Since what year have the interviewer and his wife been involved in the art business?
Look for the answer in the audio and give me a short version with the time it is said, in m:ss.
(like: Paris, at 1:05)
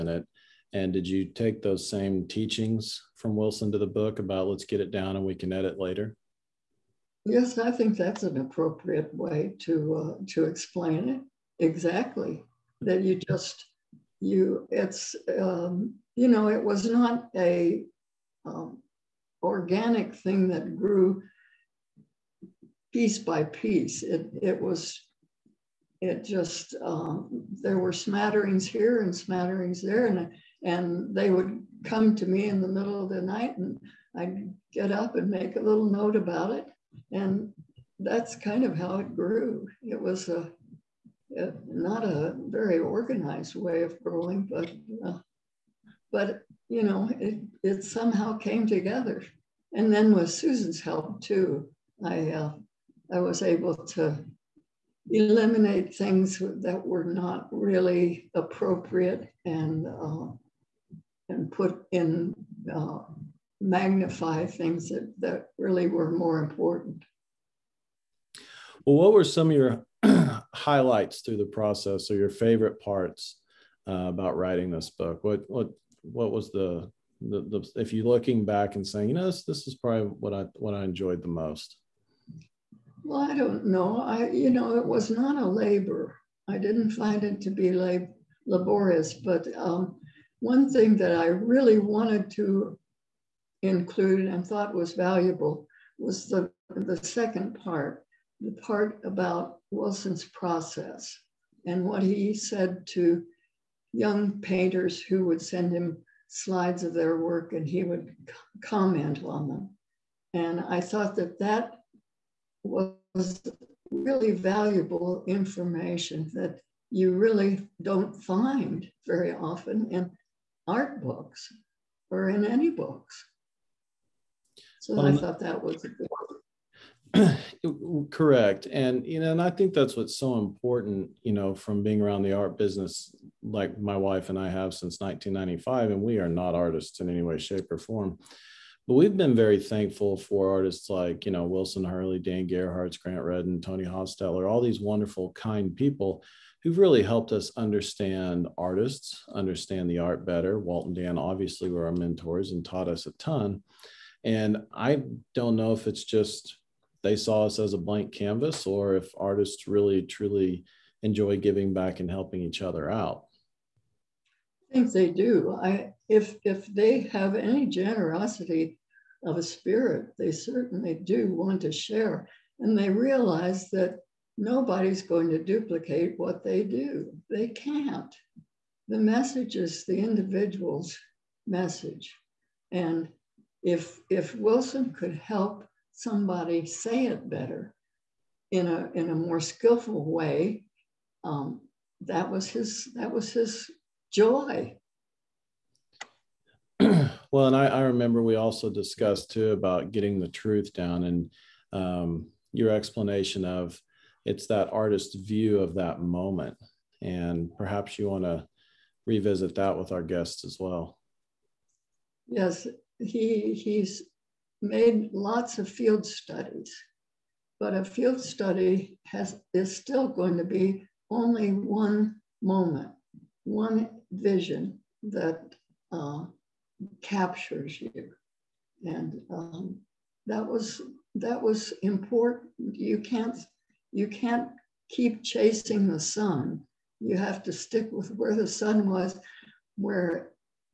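1995, at 2:14.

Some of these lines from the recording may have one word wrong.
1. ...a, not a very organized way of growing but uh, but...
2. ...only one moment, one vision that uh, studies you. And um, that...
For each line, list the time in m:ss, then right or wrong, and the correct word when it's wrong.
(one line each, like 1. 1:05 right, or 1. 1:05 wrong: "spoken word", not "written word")
1. 0:40 right
2. 3:41 wrong: "captures", not "studies".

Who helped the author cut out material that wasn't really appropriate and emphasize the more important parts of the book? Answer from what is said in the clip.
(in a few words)
Susan.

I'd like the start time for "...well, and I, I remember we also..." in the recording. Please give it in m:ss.
3:17.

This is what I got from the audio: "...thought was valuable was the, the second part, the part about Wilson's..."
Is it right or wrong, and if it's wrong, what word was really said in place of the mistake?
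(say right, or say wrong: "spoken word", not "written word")
right.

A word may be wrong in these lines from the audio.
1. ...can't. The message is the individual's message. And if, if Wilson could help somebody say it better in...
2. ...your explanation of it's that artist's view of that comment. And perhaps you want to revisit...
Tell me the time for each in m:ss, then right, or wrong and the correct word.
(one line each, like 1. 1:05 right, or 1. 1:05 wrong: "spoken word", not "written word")
1. 2:57 right
2. 3:22 wrong: "moment", not "comment".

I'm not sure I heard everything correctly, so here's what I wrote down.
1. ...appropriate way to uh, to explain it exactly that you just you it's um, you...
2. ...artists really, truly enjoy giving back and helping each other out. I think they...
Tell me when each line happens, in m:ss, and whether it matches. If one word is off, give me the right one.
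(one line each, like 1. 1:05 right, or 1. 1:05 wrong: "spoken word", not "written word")
1. 0:08 right
2. 2:39 right.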